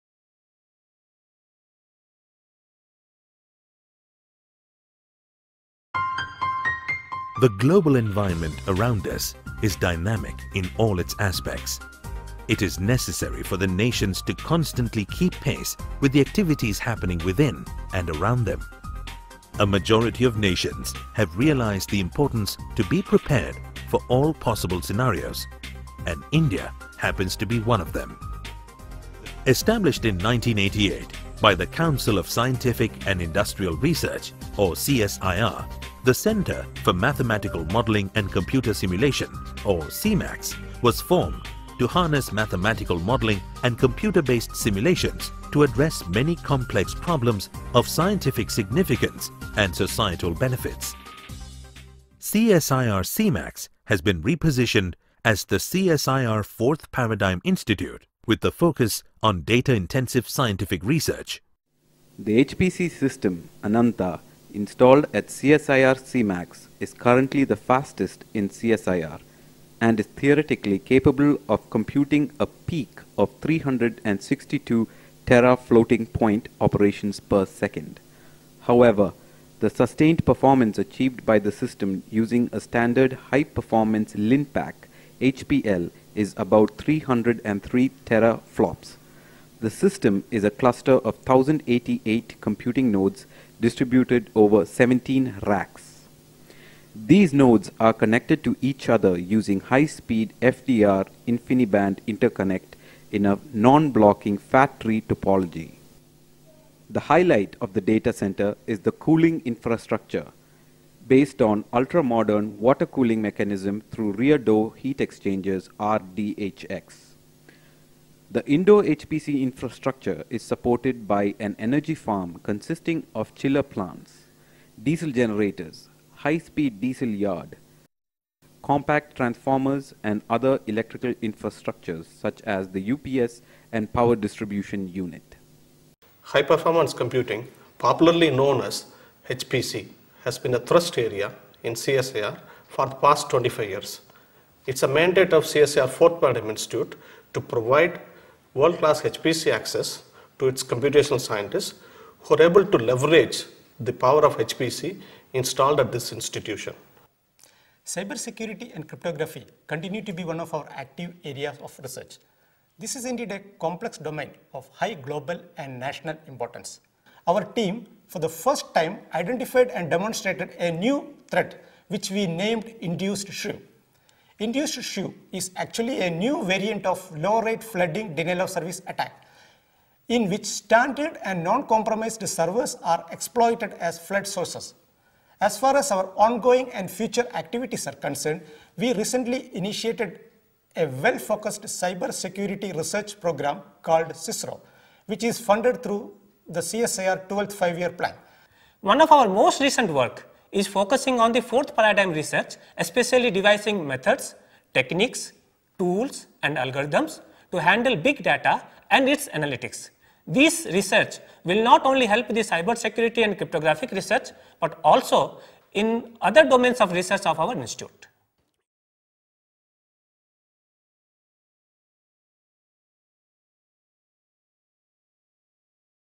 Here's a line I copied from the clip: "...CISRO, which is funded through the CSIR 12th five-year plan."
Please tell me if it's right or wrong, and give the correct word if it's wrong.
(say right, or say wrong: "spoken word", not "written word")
right.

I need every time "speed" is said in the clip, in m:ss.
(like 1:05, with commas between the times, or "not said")
1:39, 2:06.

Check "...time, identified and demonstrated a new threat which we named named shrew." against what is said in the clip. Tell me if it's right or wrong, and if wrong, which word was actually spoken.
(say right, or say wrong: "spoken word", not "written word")
wrong: "induced", not "named".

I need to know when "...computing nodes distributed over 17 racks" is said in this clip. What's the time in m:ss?
1:32.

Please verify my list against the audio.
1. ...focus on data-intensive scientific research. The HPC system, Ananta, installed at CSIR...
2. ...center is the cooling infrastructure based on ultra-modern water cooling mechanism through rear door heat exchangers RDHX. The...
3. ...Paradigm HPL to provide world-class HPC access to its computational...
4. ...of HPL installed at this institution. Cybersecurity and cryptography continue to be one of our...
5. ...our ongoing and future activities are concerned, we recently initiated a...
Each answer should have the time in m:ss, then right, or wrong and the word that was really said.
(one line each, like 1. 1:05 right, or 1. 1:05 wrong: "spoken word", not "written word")
1. 0:58 right
2. 1:48 right
3. 2:26 wrong: "Institute", not "HPL"
4. 2:34 wrong: "HPC", not "HPL"
5. 3:05 right.